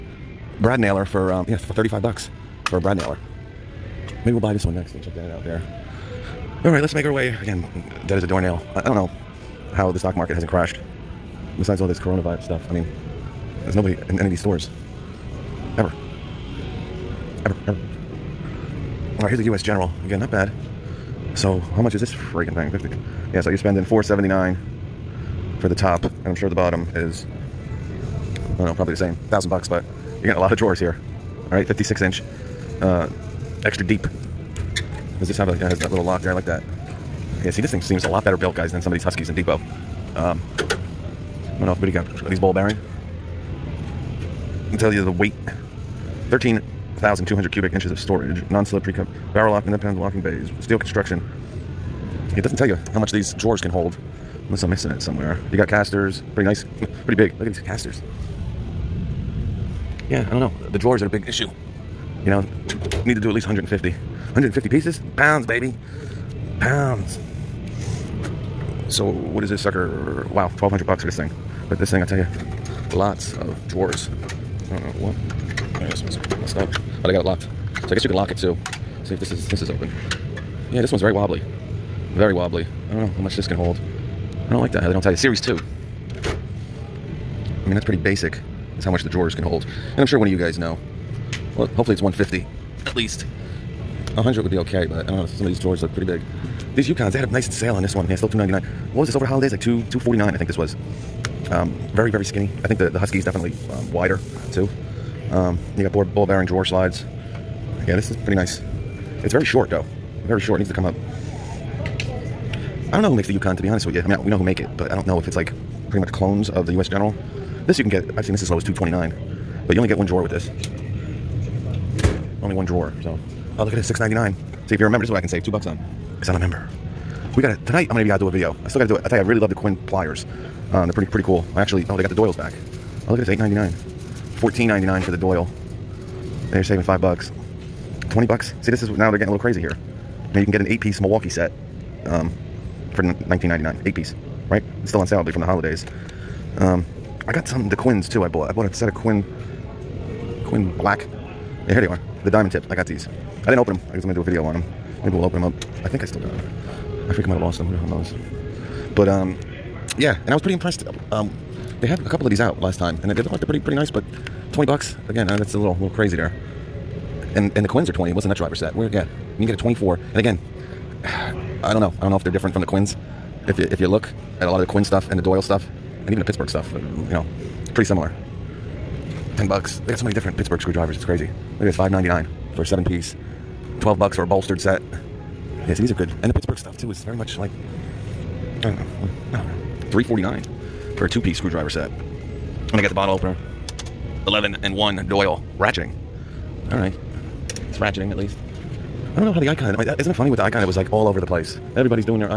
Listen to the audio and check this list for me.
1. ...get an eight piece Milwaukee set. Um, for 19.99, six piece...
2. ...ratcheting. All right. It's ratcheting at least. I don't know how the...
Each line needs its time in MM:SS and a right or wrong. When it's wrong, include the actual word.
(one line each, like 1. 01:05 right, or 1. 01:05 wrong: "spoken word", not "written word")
1. 02:20 wrong: "eight", not "six"
2. 03:15 right.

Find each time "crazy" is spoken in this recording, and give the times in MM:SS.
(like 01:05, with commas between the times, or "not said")
02:19, 02:45, 03:01.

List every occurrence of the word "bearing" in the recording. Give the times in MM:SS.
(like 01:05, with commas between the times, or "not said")
00:42, 01:46.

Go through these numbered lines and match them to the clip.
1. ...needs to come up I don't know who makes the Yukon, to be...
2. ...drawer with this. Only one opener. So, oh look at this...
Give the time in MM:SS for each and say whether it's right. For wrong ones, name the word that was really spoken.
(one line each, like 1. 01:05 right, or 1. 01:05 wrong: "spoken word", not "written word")
1. 01:50 right
2. 02:00 wrong: "drawer", not "opener".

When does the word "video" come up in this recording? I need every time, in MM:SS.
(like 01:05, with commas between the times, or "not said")
02:08, 02:34.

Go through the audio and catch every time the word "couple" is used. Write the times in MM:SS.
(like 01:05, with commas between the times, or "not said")
02:42.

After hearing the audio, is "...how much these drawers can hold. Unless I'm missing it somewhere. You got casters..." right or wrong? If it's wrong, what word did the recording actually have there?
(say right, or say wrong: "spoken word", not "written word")
right.